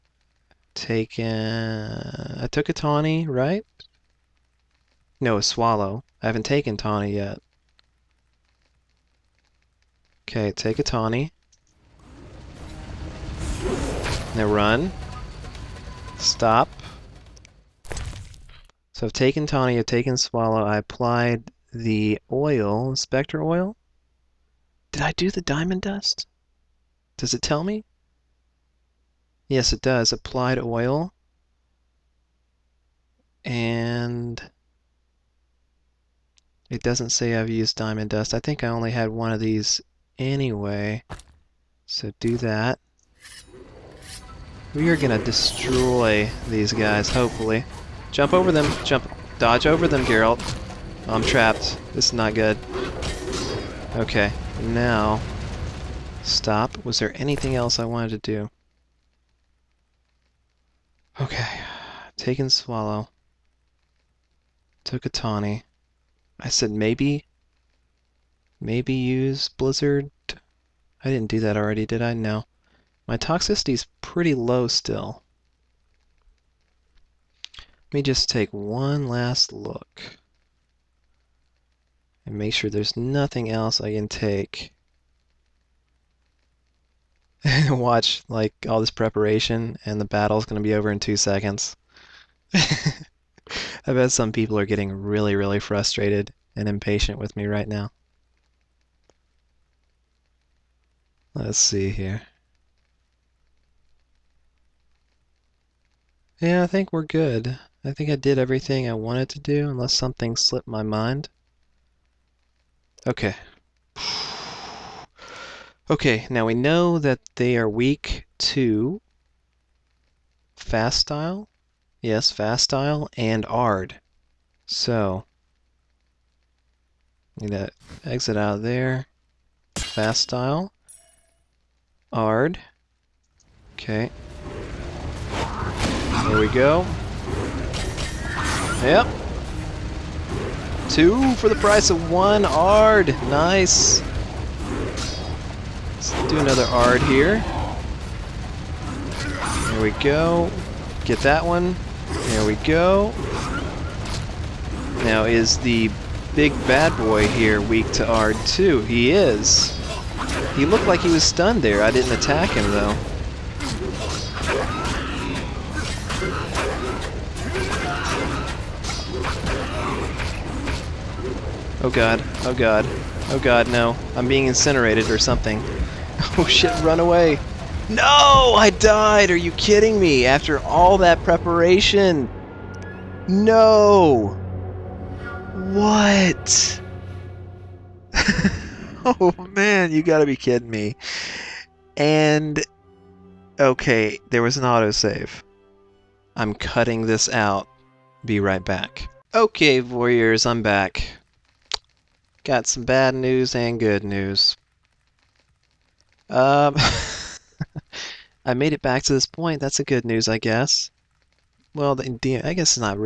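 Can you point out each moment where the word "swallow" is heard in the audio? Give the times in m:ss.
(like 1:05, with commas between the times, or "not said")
0:05, 0:20, 1:02.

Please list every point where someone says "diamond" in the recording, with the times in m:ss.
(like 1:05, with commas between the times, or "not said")
0:25, 0:37.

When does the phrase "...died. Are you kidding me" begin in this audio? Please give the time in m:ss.
2:58.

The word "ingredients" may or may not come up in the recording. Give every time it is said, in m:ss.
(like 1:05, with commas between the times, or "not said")
not said.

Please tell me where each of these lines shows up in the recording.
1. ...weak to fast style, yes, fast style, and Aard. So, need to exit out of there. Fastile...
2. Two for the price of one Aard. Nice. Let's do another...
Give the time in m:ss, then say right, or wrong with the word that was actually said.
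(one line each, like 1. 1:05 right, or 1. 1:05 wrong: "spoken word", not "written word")
1. 1:57 right
2. 2:20 right.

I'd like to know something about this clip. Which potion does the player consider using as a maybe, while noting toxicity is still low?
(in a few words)
Blizzard.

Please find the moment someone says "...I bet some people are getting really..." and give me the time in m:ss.
1:32.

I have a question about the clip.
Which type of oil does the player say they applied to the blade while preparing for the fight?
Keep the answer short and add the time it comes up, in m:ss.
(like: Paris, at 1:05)
Inspector oil, at 0:22.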